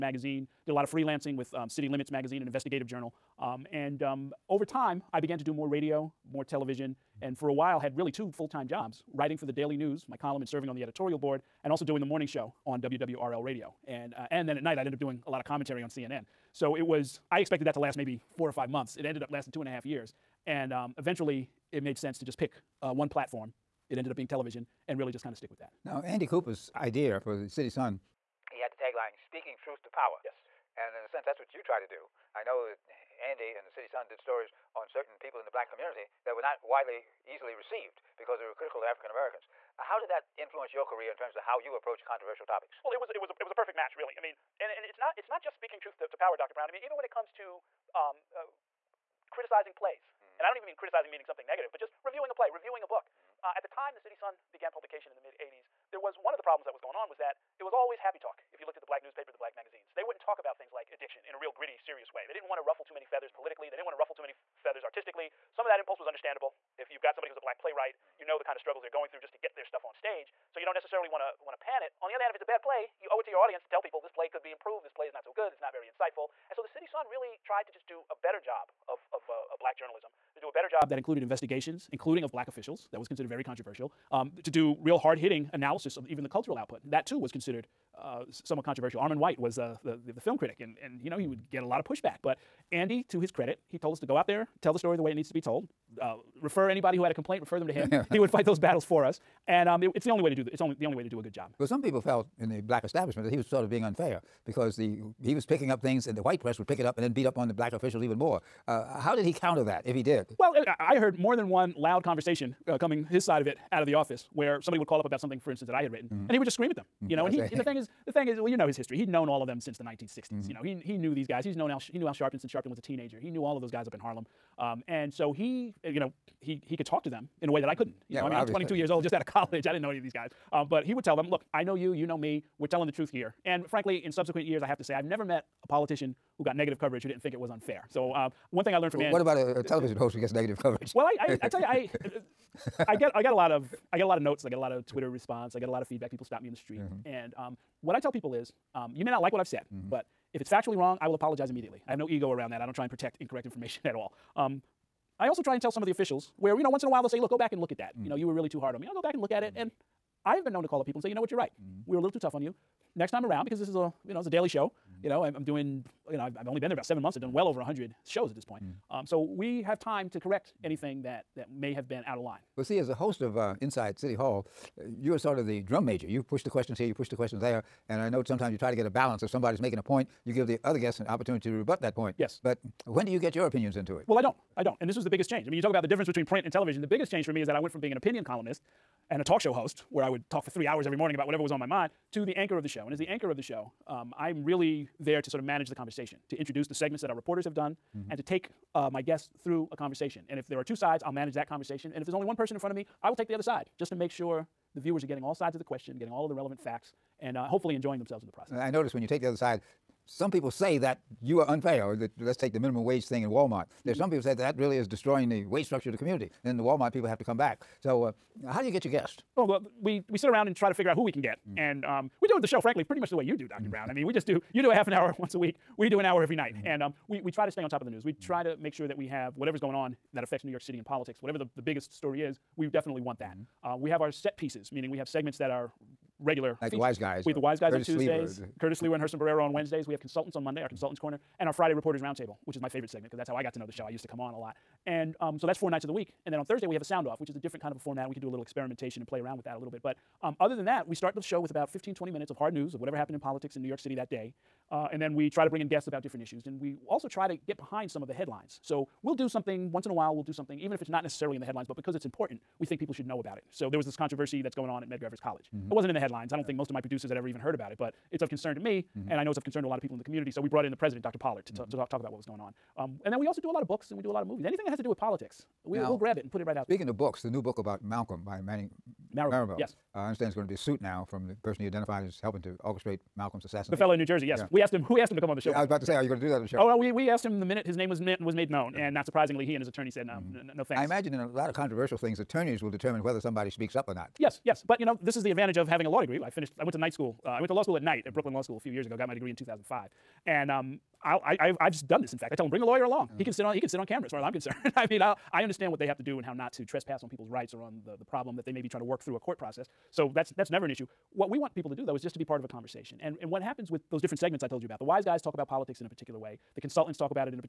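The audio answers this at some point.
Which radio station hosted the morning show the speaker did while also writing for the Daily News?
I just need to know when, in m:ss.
0:12.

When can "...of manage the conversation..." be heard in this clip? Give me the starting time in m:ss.
3:15.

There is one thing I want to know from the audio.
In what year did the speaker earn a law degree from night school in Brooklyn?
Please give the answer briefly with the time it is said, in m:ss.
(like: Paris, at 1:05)
2005, at 4:59.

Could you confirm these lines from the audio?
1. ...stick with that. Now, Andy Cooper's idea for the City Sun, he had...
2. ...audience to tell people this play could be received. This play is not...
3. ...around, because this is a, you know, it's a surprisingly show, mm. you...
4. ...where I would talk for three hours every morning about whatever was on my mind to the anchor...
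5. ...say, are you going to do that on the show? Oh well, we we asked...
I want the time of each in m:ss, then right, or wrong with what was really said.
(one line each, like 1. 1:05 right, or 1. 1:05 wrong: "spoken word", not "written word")
1. 0:25 right
2. 1:13 wrong: "improved", not "received"
3. 2:43 wrong: "daily", not "surprisingly"
4. 3:09 right
5. 4:45 right.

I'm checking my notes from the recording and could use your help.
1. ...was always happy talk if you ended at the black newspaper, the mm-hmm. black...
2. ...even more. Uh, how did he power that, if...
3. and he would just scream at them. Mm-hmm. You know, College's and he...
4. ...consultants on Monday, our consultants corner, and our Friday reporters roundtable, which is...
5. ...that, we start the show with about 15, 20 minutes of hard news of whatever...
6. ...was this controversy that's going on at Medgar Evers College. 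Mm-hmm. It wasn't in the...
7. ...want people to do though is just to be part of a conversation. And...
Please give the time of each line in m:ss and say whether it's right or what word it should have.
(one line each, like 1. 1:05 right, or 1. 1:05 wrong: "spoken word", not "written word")
1. 0:57 wrong: "looked", not "ended"
2. 1:48 wrong: "counter", not "power"
3. 1:56 wrong: "That", not "College"
4. 3:59 right
5. 4:10 right
6. 4:23 right
7. 5:11 right.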